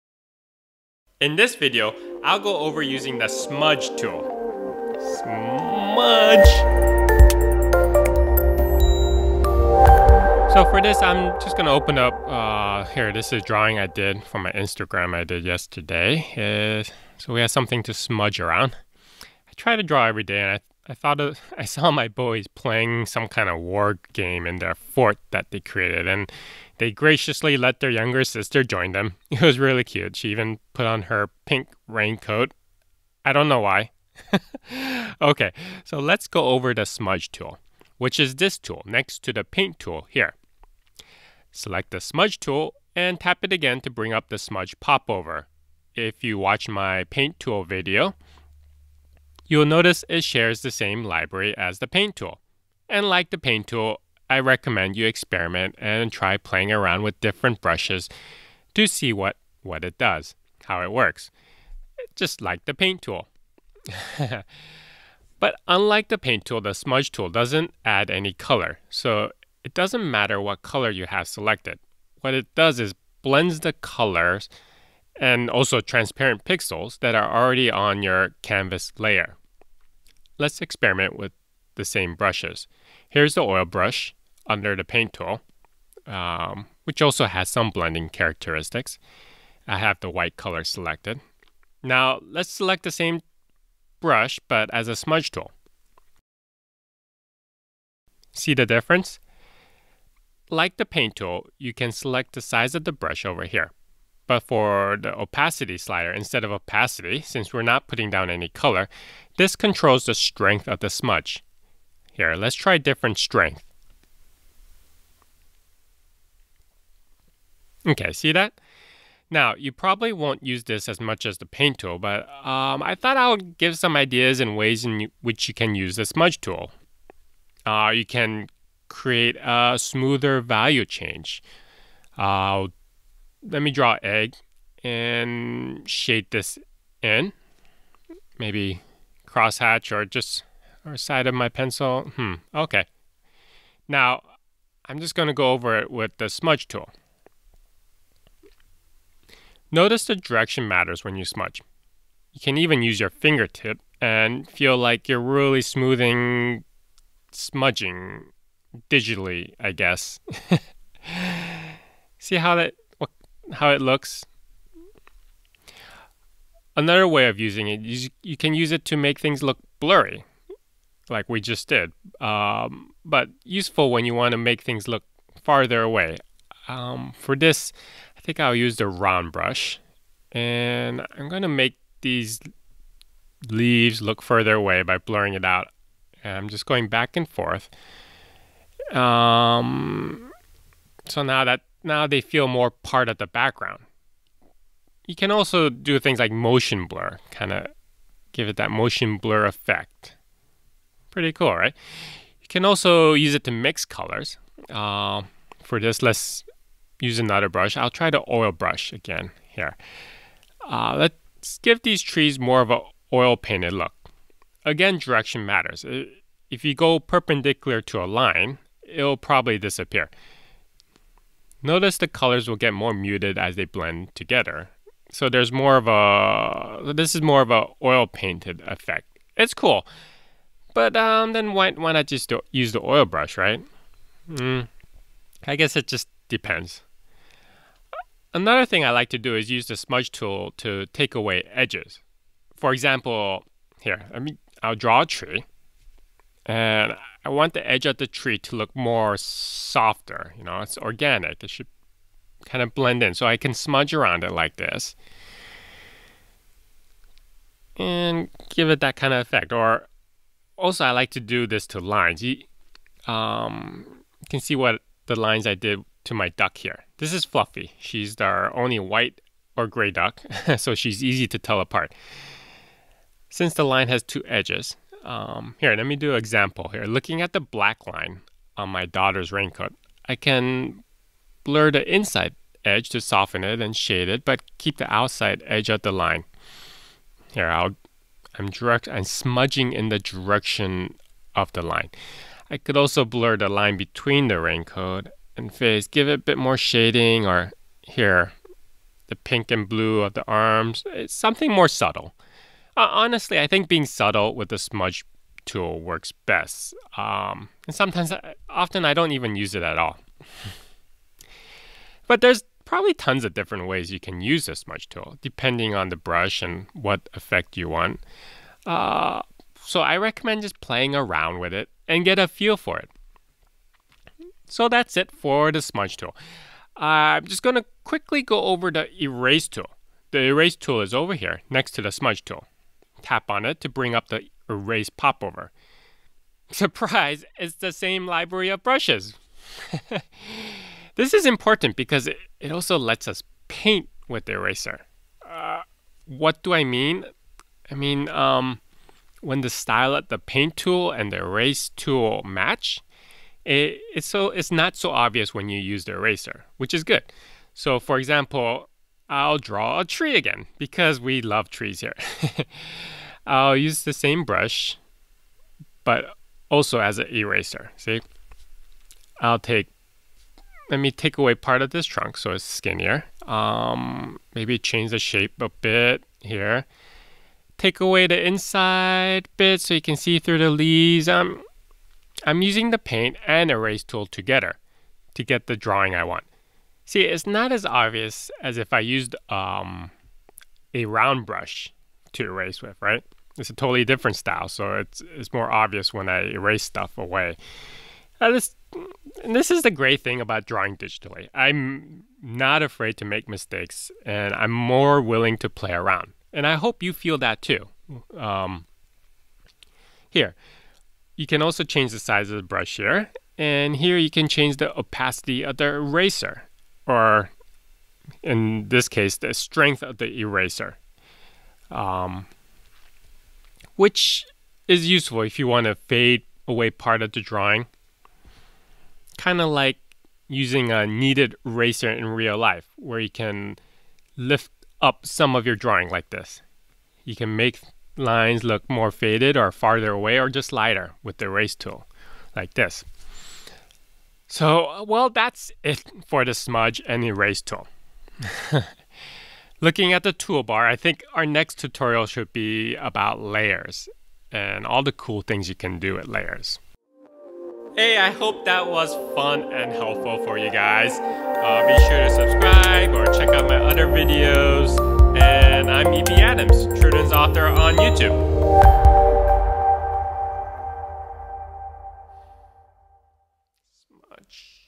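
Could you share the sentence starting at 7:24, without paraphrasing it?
So, uh, well, that's it for the smudge and erase tool.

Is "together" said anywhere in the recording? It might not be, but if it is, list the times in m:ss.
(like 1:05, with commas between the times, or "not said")
3:44, 6:24.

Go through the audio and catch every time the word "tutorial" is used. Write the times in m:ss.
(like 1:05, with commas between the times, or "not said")
7:31.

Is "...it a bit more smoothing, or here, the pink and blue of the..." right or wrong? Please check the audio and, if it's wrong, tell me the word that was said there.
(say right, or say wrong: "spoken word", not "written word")
wrong: "shading", not "smoothing".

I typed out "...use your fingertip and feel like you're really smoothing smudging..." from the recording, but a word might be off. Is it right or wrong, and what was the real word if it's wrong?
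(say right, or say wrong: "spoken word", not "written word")
right.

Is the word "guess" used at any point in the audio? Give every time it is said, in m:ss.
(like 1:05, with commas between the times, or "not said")
2:39, 3:55.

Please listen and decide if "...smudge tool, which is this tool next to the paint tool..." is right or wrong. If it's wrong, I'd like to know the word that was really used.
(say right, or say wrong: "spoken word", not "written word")
right.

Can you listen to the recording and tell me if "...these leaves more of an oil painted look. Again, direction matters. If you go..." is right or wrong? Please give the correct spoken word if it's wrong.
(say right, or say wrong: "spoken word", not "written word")
wrong: "trees", not "leaves".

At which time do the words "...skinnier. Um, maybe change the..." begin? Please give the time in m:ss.
6:12.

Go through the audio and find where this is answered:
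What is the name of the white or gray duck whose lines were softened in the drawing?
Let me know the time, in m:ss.
4:27.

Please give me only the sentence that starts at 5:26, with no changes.
Uh, I'm just going to quickly go over the erase tool.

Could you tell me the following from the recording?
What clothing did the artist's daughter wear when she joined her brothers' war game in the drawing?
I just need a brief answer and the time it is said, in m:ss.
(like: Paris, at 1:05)
pink raincoat, at 0:31.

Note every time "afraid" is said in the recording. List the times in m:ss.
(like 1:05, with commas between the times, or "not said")
6:42.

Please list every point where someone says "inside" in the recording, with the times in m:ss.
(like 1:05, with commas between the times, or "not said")
4:41, 6:18.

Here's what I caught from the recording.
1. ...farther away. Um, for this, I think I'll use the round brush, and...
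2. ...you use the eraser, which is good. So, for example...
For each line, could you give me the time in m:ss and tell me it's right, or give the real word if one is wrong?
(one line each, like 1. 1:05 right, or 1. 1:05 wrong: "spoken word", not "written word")
1. 2:55 right
2. 5:55 right.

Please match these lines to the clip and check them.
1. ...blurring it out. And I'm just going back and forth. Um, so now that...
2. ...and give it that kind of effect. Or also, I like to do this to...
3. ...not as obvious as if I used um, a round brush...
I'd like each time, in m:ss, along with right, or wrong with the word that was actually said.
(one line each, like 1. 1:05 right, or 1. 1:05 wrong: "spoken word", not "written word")
1. 3:04 right
2. 4:17 right
3. 6:27 right.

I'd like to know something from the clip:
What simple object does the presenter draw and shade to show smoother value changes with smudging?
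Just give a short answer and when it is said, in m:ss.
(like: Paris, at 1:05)
egg, at 2:14.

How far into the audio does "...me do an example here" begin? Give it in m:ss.
4:35.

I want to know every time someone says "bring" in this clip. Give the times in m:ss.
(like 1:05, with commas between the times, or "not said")
0:43, 5:33.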